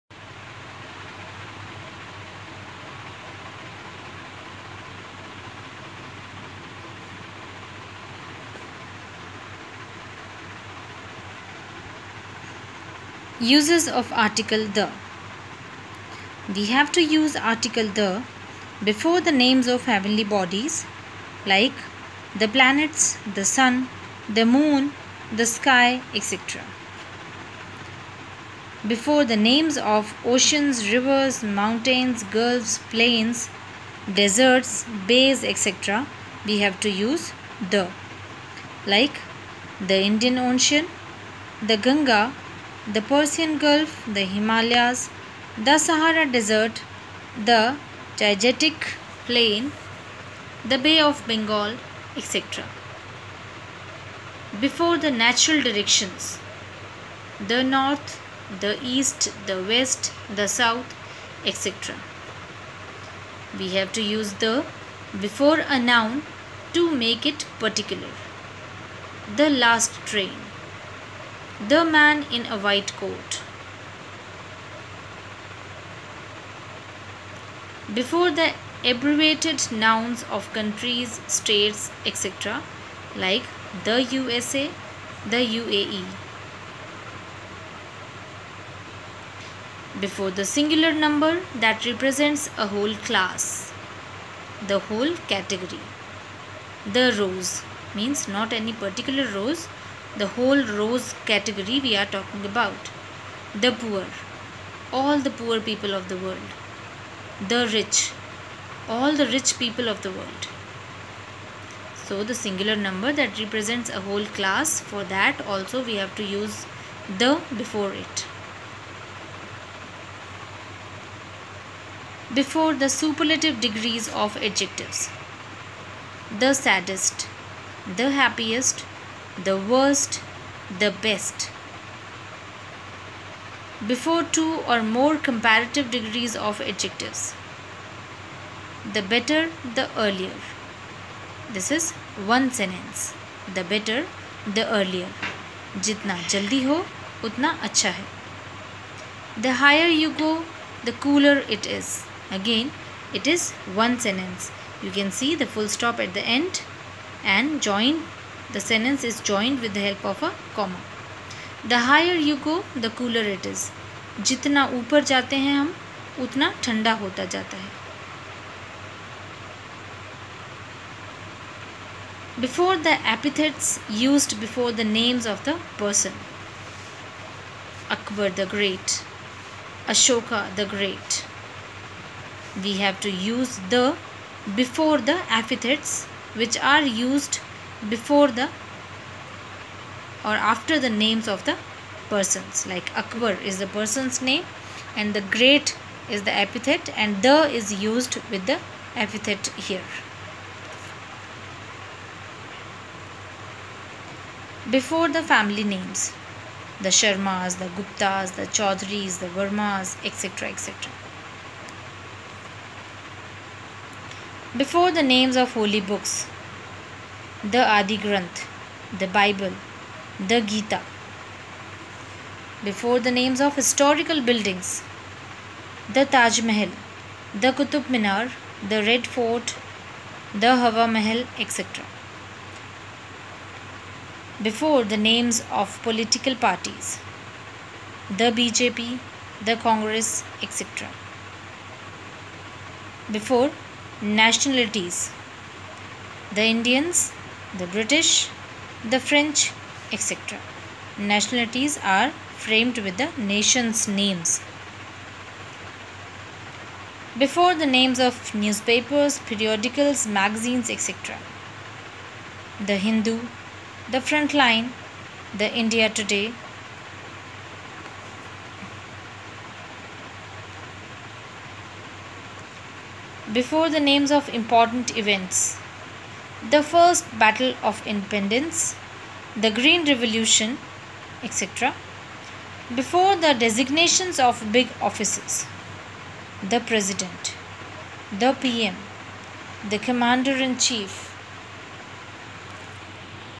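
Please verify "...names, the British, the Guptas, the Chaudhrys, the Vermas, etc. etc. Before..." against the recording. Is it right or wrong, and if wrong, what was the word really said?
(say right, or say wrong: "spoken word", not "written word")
wrong: "Sharmas", not "British".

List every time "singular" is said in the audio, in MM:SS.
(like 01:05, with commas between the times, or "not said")
01:30, 01:52.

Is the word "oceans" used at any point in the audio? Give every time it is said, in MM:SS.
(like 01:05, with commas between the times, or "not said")
00:30, 00:40.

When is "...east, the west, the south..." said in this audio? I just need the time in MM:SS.
00:58.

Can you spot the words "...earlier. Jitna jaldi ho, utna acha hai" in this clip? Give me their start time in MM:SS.
02:24.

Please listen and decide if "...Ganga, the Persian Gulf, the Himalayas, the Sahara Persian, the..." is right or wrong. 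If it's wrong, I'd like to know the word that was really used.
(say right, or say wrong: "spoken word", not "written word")
wrong: "Desert", not "Persian".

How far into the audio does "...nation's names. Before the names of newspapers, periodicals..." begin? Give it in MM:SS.
04:13.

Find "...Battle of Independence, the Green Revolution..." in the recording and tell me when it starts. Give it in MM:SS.
04:37.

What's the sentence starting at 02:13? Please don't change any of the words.
Before two or more comparative degrees of adjectives.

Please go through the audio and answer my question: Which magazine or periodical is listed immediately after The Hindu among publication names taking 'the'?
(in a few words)
Frontline.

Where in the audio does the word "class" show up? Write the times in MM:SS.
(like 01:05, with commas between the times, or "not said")
01:33, 01:54.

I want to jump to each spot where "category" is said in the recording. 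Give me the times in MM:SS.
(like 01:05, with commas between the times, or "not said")
01:35, 01:41.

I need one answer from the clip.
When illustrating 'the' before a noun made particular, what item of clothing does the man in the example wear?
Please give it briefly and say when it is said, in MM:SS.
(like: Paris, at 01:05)
white coat, at 01:12.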